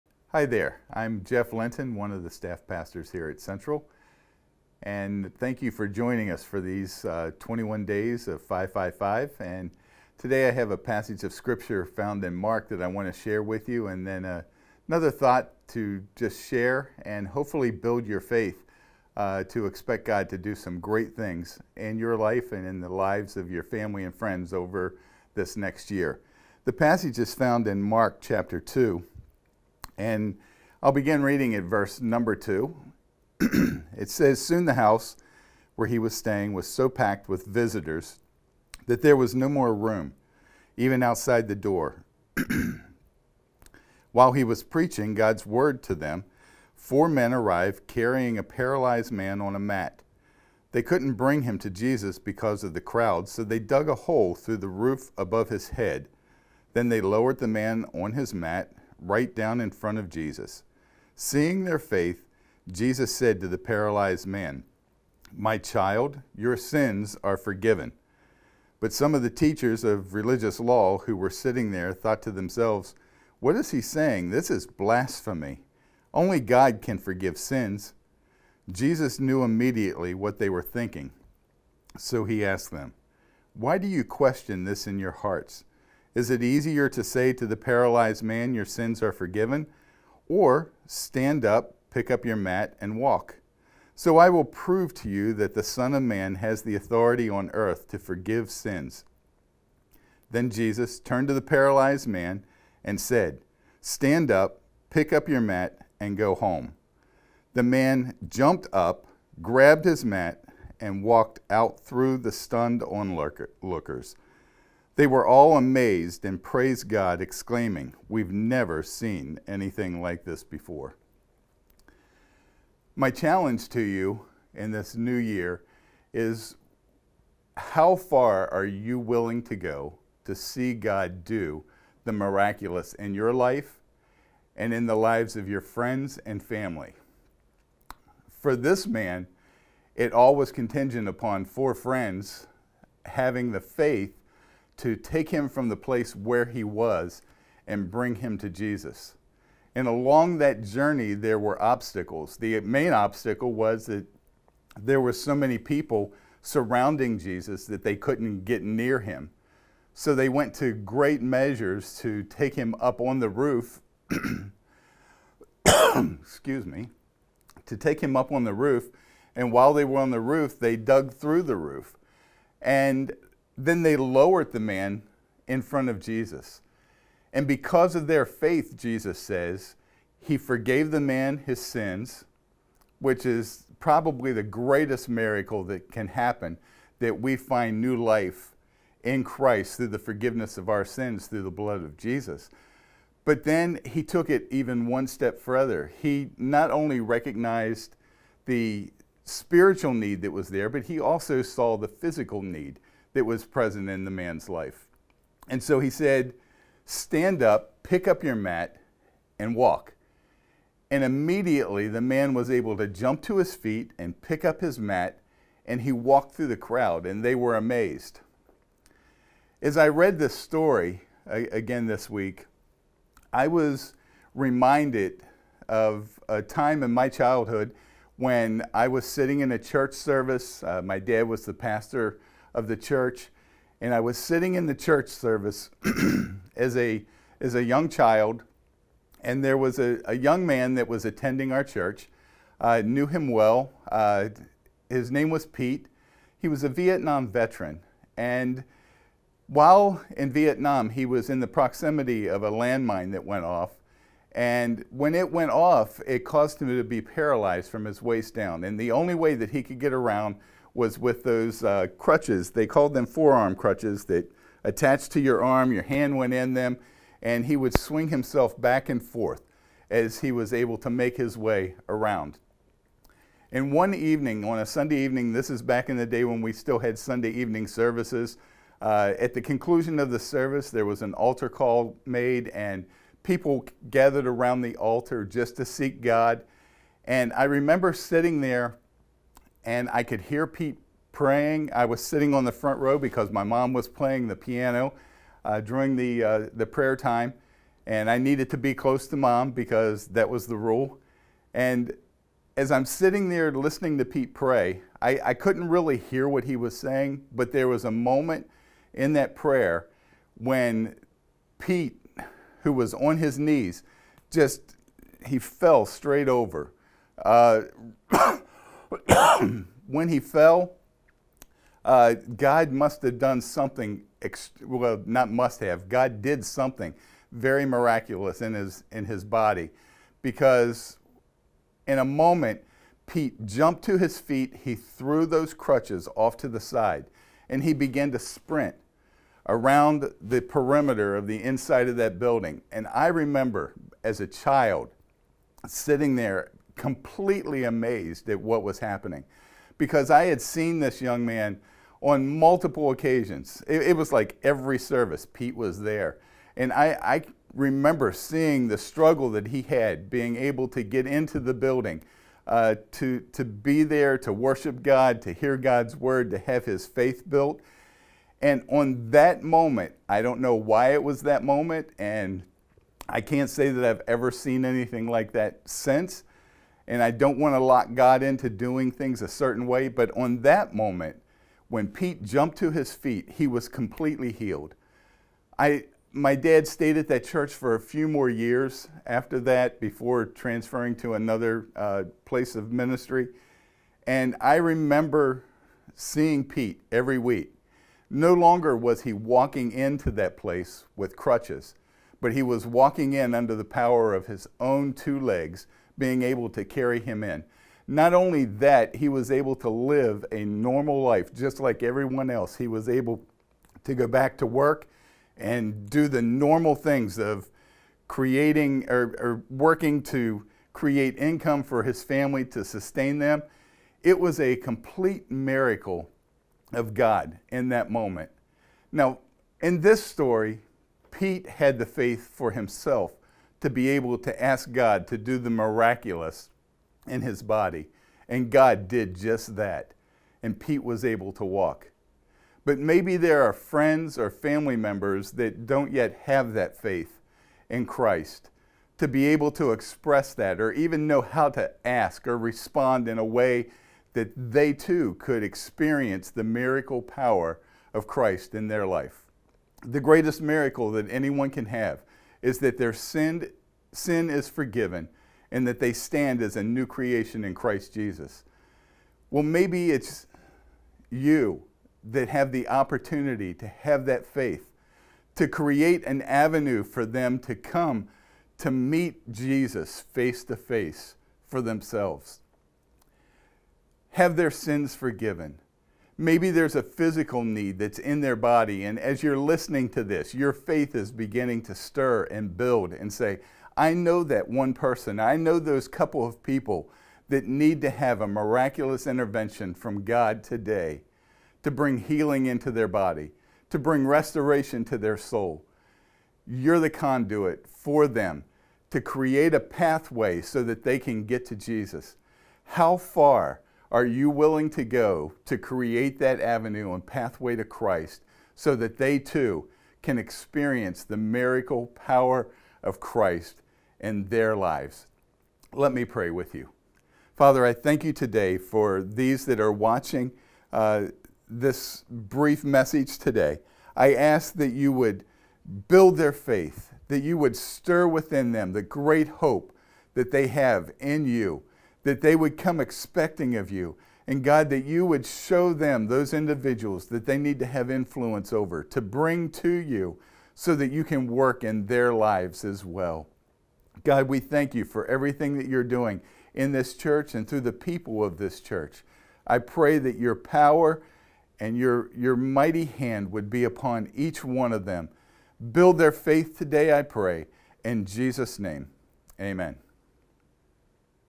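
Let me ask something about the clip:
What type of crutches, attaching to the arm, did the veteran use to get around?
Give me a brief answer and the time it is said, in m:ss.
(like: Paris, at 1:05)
forearm crutches, at 4:23.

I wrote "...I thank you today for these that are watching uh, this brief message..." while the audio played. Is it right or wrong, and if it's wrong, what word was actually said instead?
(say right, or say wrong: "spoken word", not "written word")
right.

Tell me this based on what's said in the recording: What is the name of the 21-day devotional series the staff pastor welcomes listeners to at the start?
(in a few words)
555.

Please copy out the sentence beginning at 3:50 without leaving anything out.
Uh, my dad was the pastor of the church.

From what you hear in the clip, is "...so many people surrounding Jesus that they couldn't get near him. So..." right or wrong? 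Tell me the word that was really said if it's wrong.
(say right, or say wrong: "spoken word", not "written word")
right.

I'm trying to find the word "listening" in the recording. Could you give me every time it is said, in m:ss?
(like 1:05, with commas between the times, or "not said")
5:03, 8:09.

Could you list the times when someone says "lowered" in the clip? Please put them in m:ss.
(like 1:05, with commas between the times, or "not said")
0:57, 2:53.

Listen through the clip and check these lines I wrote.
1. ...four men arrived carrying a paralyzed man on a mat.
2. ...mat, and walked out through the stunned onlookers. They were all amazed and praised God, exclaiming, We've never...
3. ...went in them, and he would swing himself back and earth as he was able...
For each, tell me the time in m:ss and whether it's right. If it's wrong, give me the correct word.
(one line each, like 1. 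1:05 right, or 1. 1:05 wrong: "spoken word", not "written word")
1. 0:46 right
2. 1:50 right
3. 4:26 wrong: "forth", not "earth".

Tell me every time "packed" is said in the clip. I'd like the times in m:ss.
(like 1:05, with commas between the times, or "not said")
0:36.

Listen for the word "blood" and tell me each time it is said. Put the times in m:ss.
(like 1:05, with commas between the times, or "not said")
3:11.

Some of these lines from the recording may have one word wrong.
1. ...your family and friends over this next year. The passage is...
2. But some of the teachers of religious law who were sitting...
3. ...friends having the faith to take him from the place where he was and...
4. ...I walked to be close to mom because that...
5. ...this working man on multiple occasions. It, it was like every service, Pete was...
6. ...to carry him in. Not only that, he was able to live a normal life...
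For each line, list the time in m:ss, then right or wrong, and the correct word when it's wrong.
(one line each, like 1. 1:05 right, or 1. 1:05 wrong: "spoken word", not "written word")
1. 0:23 right
2. 1:08 right
3. 2:21 right
4. 4:58 wrong: "needed", not "walked"
5. 5:50 wrong: "young", not "working"
6. 6:46 right.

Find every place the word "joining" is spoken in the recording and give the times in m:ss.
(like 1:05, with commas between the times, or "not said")
0:05.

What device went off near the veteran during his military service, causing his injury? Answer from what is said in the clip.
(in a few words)
a landmine.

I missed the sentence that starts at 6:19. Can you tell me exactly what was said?
But on that moment, when Pete jumped to his feet, he was completely healed.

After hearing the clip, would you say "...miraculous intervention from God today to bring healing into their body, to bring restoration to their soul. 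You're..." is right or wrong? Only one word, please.
right.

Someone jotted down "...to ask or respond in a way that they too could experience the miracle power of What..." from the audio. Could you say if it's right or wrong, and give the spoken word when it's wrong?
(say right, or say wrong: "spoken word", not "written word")
wrong: "Christ", not "What".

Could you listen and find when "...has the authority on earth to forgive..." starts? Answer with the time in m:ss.
1:36.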